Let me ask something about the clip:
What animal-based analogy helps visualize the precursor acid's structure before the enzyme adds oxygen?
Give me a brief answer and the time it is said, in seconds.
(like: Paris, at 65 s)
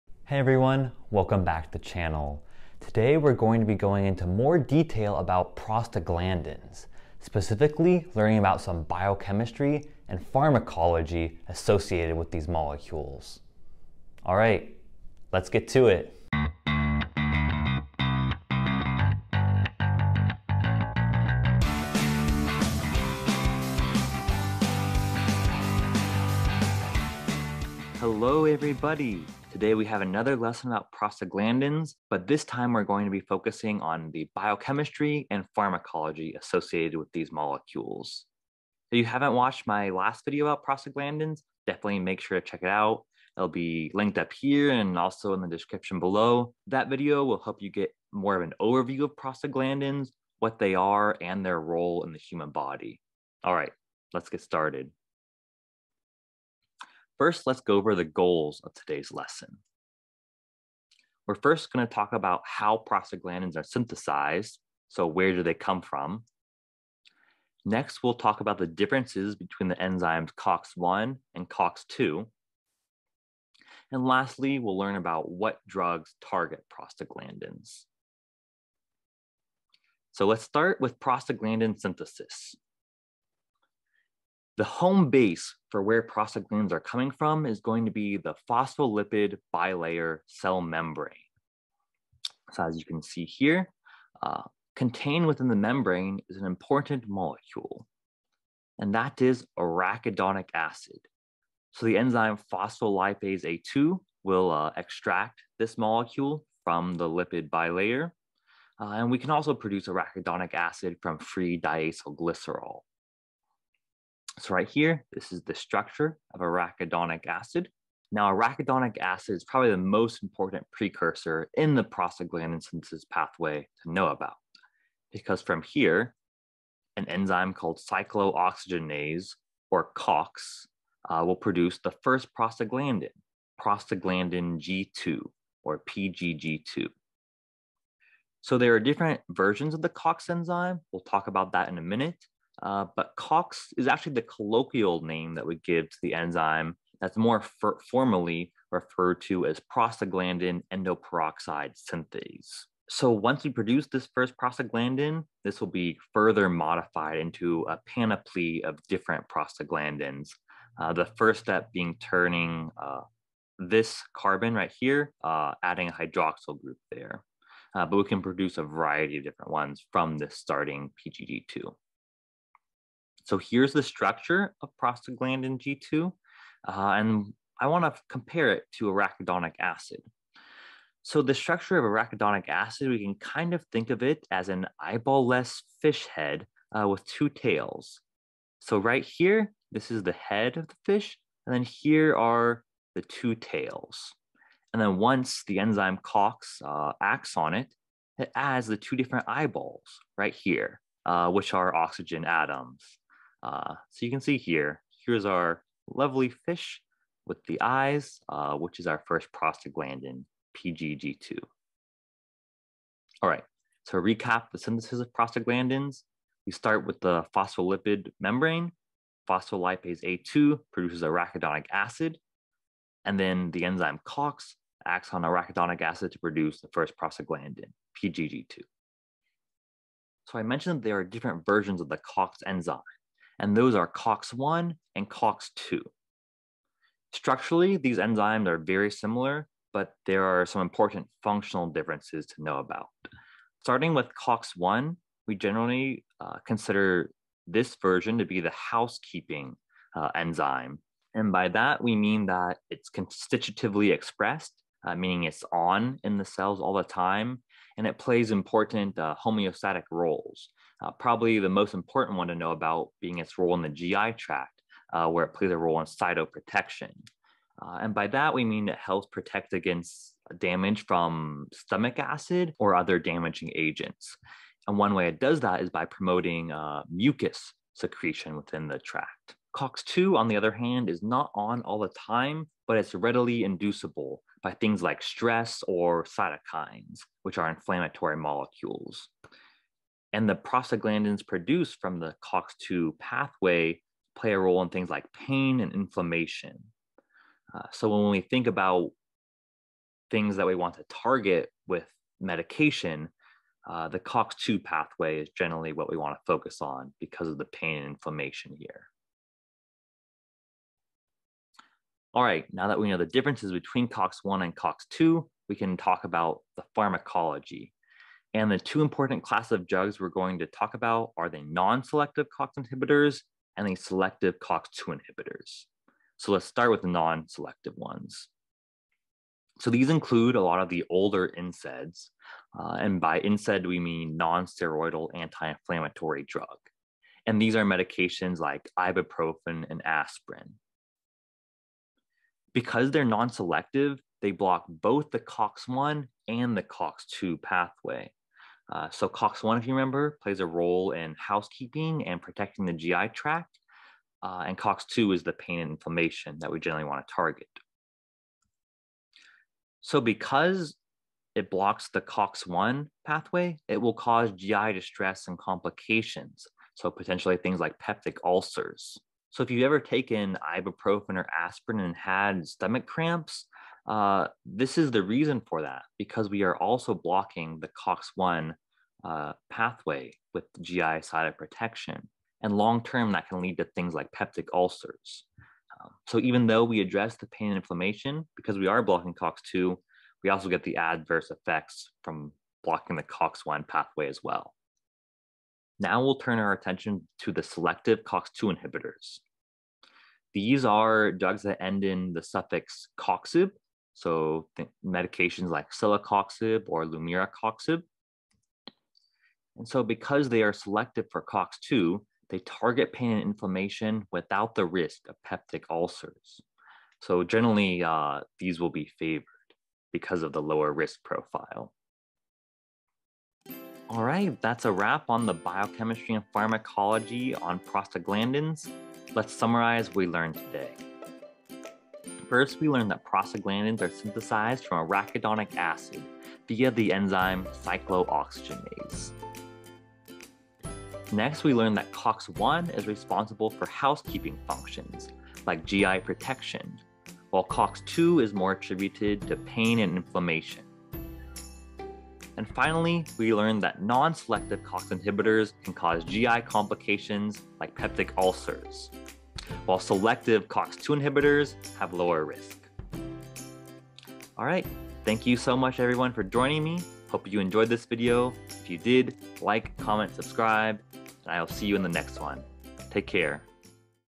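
An eyeball-less fish head, at 184 s.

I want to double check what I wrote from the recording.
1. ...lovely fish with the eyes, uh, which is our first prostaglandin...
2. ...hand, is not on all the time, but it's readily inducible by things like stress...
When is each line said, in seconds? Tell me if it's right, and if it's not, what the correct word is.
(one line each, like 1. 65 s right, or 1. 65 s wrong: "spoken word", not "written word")
1. 205 s right
2. 280 s right.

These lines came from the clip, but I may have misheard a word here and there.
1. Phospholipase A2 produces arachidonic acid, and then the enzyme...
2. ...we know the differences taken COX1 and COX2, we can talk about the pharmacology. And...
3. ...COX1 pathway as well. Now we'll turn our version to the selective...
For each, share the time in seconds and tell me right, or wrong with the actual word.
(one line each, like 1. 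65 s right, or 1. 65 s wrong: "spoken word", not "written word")
1. 219 s right
2. 312 s wrong: "between", not "taken"
3. 393 s wrong: "attention", not "version".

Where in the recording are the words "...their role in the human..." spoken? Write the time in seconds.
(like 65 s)
51 s.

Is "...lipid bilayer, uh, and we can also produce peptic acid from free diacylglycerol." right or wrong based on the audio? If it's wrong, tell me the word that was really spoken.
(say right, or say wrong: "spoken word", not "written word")
wrong: "arachidonic", not "peptic".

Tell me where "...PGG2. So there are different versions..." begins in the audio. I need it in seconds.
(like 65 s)
135 s.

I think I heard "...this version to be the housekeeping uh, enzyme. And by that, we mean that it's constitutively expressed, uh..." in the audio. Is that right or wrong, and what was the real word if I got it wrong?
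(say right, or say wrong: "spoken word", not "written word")
right.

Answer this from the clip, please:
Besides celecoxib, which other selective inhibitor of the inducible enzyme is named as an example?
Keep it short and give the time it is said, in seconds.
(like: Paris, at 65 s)
Lumiracoxib, at 406 s.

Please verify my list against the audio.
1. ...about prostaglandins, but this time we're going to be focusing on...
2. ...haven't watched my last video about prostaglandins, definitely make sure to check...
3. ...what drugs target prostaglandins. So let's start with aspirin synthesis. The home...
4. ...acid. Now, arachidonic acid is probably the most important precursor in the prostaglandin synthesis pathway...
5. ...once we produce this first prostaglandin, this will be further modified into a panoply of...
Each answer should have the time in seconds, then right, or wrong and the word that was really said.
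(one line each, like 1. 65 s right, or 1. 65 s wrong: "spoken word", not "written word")
1. 30 s right
2. 39 s right
3. 75 s wrong: "prostaglandin", not "aspirin"
4. 117 s right
5. 153 s right.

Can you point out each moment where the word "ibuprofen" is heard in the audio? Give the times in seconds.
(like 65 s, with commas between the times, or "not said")
338 s, 370 s.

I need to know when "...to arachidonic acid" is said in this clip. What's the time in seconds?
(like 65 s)
178 s.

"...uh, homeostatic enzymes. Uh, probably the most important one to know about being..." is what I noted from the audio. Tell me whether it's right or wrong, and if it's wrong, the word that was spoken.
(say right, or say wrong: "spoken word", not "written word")
wrong: "roles", not "enzymes".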